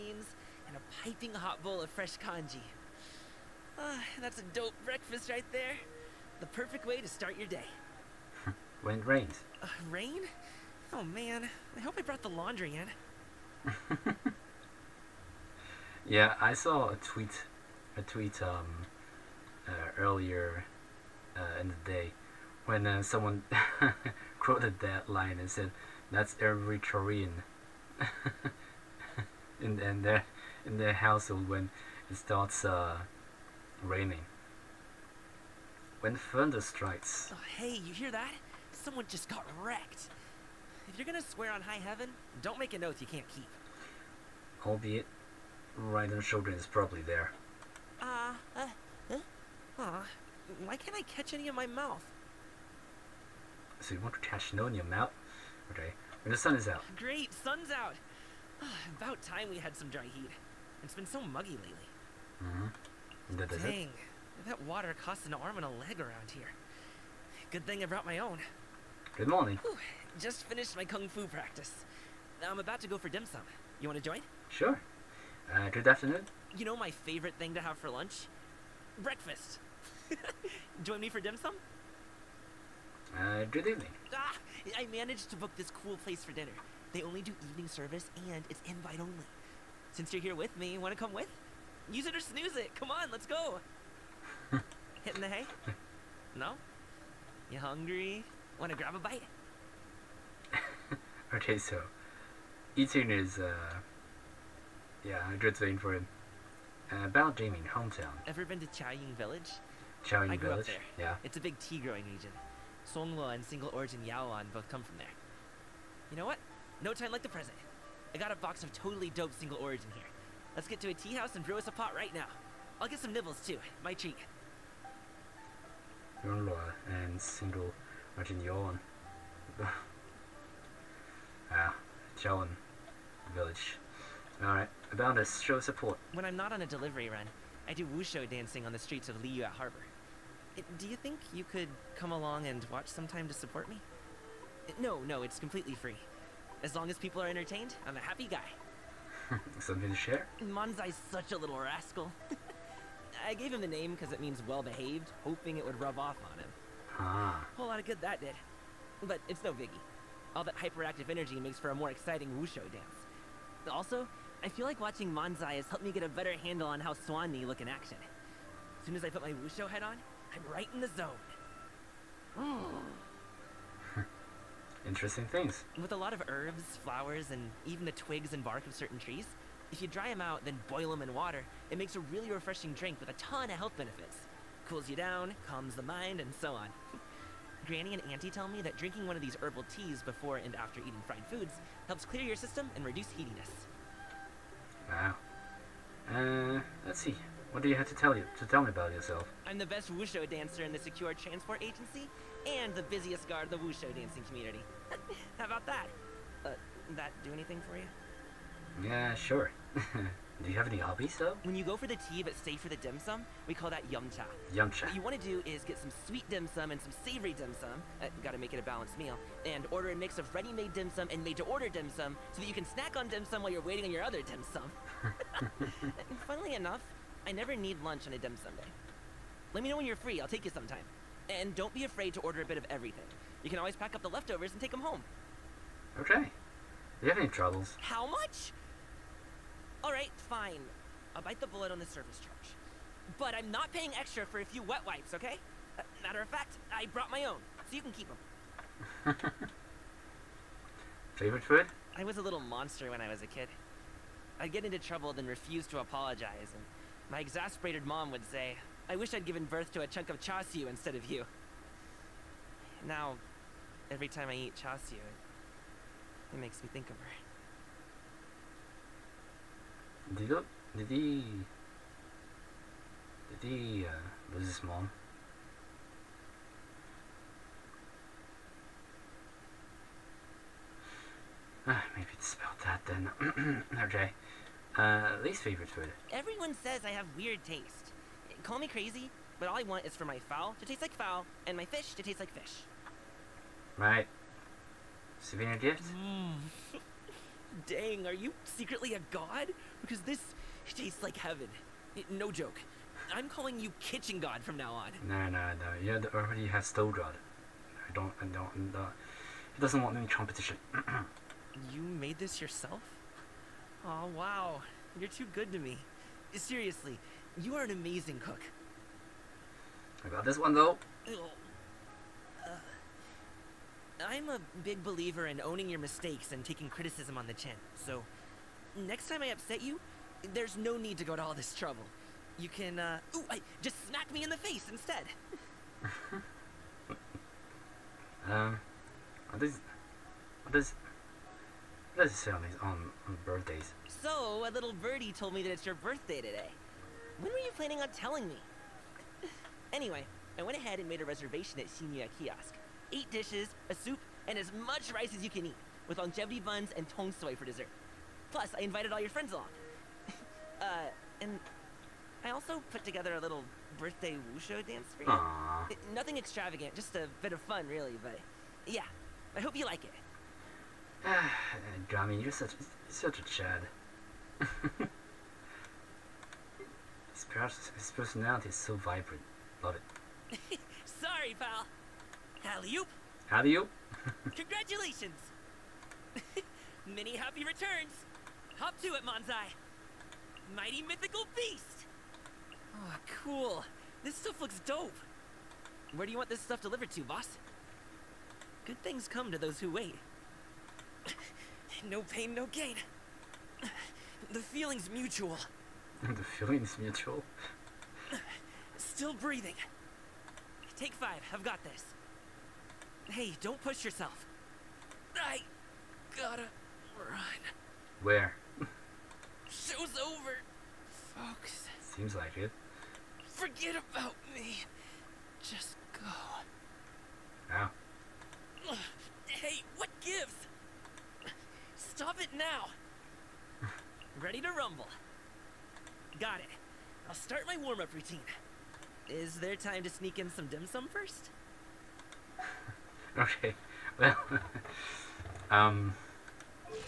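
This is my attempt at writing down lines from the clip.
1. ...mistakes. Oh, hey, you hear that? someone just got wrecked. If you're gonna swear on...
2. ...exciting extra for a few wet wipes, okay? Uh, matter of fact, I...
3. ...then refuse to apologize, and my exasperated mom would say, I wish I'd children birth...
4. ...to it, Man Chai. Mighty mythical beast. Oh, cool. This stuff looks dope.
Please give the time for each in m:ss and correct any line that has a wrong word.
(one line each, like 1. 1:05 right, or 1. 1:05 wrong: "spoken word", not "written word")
1. 0:36 wrong: "strikes", not "mistakes"
2. 4:03 wrong: "paying", not "exciting"
3. 4:15 wrong: "given", not "children"
4. 6:28 right.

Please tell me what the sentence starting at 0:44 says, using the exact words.
Albeit, the children is probably there.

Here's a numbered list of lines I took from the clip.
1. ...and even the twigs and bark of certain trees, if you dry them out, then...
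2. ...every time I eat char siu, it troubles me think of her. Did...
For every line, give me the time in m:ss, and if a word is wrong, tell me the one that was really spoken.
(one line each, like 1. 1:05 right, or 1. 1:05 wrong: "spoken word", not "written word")
1. 2:57 right
2. 4:23 wrong: "makes", not "troubles".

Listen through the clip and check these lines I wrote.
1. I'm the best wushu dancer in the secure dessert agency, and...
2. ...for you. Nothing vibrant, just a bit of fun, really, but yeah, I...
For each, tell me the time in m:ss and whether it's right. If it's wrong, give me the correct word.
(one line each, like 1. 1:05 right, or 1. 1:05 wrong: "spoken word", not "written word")
1. 3:19 wrong: "transport", not "dessert"
2. 6:04 wrong: "extravagant", not "vibrant".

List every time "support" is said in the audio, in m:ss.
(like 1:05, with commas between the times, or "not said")
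2:15, 2:23.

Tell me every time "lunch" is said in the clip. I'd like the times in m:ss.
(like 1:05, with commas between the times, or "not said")
1:17, 3:47.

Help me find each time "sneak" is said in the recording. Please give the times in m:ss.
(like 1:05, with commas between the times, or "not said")
7:19.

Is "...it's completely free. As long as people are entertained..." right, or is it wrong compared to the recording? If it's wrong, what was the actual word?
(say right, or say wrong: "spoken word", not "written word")
right.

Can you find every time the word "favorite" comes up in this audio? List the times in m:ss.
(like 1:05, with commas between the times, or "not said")
1:16, 4:11, 4:45.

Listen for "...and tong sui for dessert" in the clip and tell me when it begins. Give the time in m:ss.
5:56.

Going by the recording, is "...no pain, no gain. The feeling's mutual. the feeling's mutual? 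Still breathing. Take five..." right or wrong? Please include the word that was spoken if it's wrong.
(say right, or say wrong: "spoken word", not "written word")
right.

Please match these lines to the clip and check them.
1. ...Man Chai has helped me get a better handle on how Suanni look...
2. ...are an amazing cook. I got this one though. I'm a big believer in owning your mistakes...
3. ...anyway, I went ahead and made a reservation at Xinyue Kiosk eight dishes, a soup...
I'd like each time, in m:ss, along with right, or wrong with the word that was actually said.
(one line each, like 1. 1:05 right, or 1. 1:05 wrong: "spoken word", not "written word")
1. 2:45 right
2. 5:17 right
3. 5:49 right.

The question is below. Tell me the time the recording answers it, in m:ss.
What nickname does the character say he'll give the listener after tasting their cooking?
5:03.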